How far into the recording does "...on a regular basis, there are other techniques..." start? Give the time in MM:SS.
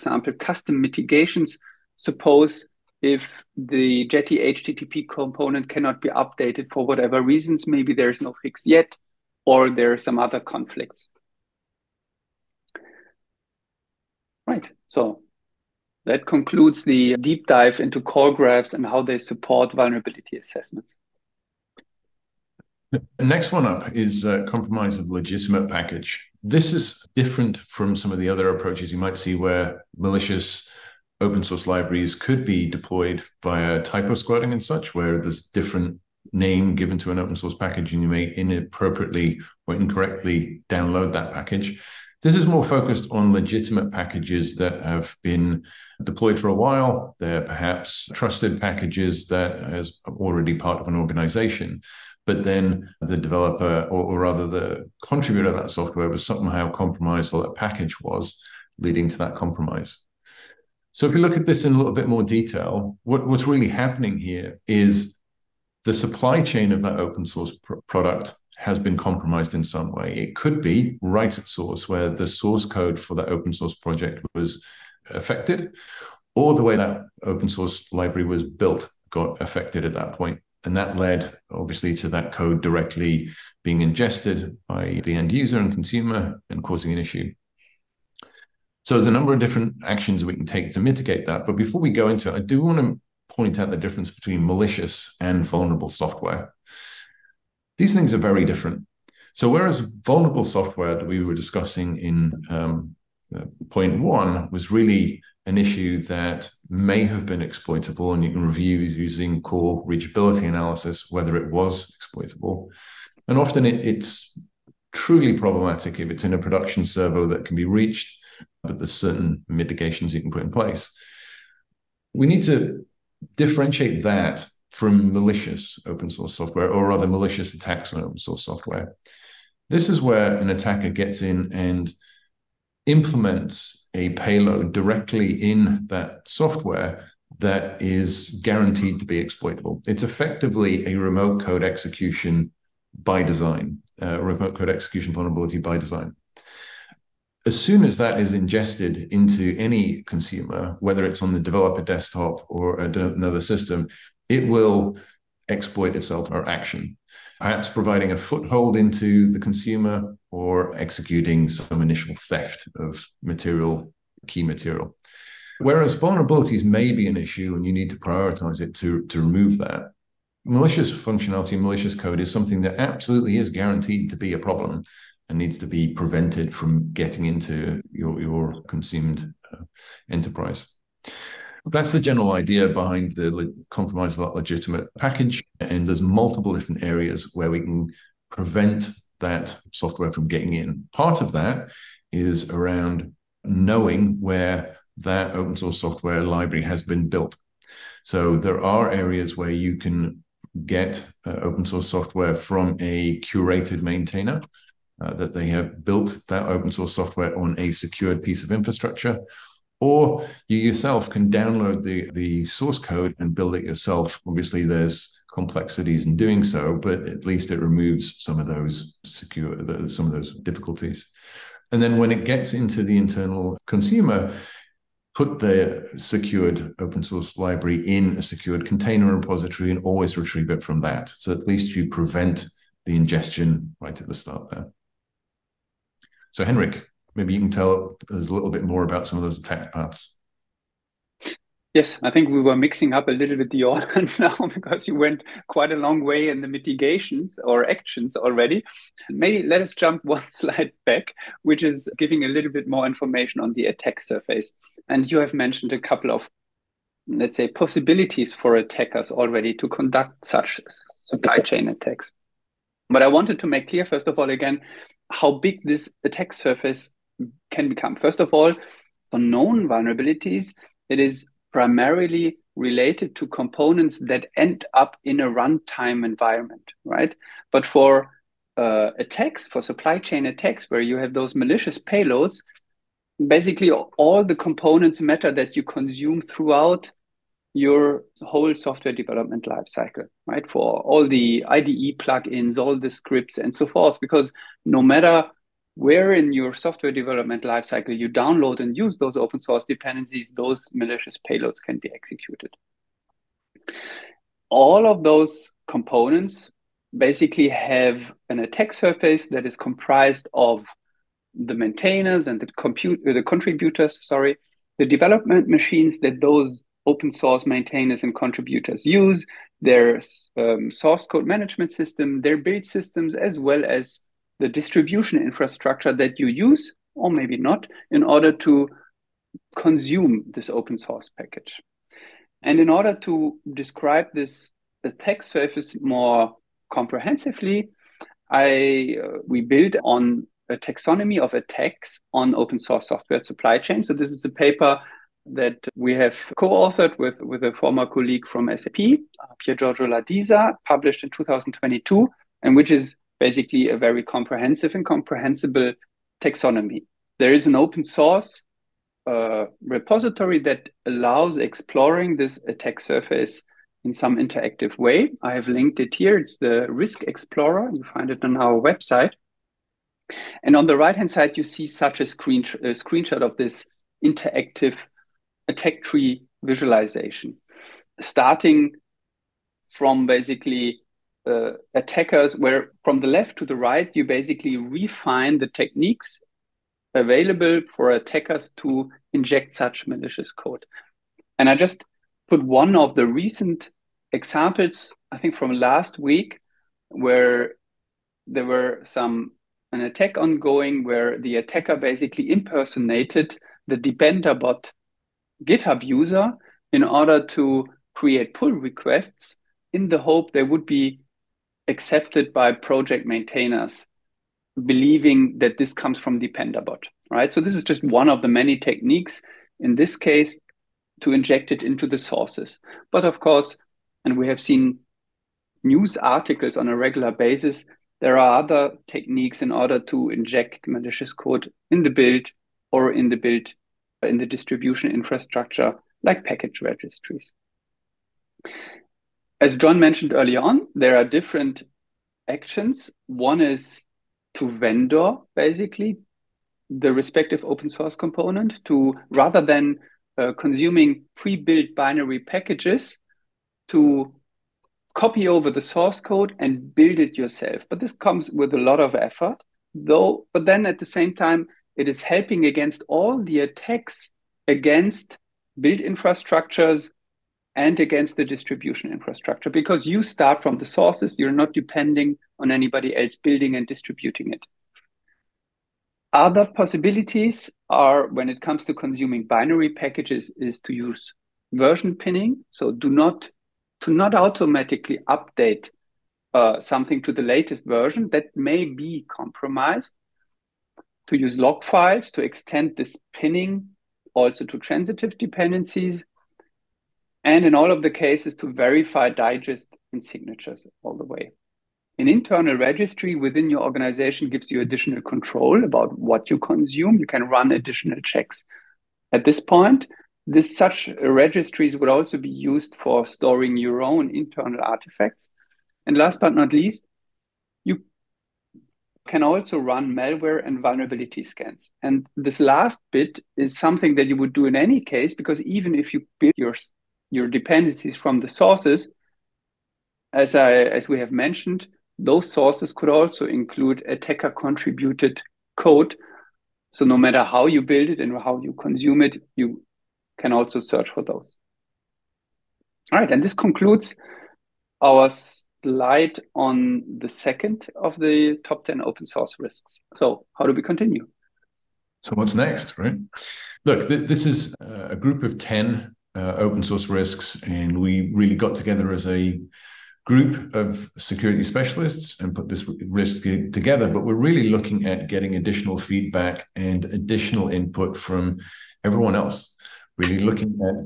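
07:06.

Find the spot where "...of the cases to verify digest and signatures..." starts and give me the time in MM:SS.
08:17.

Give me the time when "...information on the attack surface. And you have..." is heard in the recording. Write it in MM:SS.
04:12.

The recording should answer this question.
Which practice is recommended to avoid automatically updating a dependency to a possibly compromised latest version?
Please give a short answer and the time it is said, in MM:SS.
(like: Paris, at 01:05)
version pinning, at 08:01.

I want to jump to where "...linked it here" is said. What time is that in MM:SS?
06:05.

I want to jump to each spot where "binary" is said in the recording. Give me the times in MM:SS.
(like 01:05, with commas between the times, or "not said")
07:31, 07:59.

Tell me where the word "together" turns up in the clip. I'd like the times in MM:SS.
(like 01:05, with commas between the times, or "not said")
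09:18, 09:23.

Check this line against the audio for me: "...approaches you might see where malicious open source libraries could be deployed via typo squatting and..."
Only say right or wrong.
right.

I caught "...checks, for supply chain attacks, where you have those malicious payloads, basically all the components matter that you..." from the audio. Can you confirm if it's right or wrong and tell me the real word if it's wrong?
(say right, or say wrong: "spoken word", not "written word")
wrong: "attacks", not "checks".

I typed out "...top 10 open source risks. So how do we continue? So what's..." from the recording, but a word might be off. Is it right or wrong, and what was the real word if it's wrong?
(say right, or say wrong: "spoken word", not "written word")
right.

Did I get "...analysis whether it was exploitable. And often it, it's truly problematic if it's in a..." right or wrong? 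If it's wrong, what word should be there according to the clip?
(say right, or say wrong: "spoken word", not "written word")
right.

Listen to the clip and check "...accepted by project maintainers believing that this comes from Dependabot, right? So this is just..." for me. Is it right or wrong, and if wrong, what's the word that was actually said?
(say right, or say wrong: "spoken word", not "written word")
right.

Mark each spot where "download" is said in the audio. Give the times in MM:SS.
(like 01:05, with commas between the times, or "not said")
00:40, 03:31, 04:58.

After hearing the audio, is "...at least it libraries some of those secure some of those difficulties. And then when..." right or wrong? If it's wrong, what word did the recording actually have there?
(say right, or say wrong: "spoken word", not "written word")
wrong: "removes", not "libraries".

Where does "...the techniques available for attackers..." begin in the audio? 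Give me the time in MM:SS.
06:25.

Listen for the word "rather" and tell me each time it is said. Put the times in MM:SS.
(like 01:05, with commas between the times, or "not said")
00:54, 02:06, 07:29.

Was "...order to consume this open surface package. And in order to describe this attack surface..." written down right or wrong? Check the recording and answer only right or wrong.
wrong.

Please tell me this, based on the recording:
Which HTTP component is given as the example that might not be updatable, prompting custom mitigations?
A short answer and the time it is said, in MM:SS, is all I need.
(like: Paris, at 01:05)
Jetty, at 00:04.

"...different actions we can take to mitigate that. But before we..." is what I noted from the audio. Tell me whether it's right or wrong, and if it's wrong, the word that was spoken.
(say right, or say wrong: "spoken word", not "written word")
right.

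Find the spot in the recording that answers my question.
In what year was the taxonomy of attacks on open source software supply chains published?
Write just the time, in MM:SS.
05:51.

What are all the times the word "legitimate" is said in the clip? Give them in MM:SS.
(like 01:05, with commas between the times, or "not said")
00:25, 00:43, 03:04.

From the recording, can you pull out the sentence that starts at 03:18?
So there are areas where you can get uh, open source software from a curated maintainer.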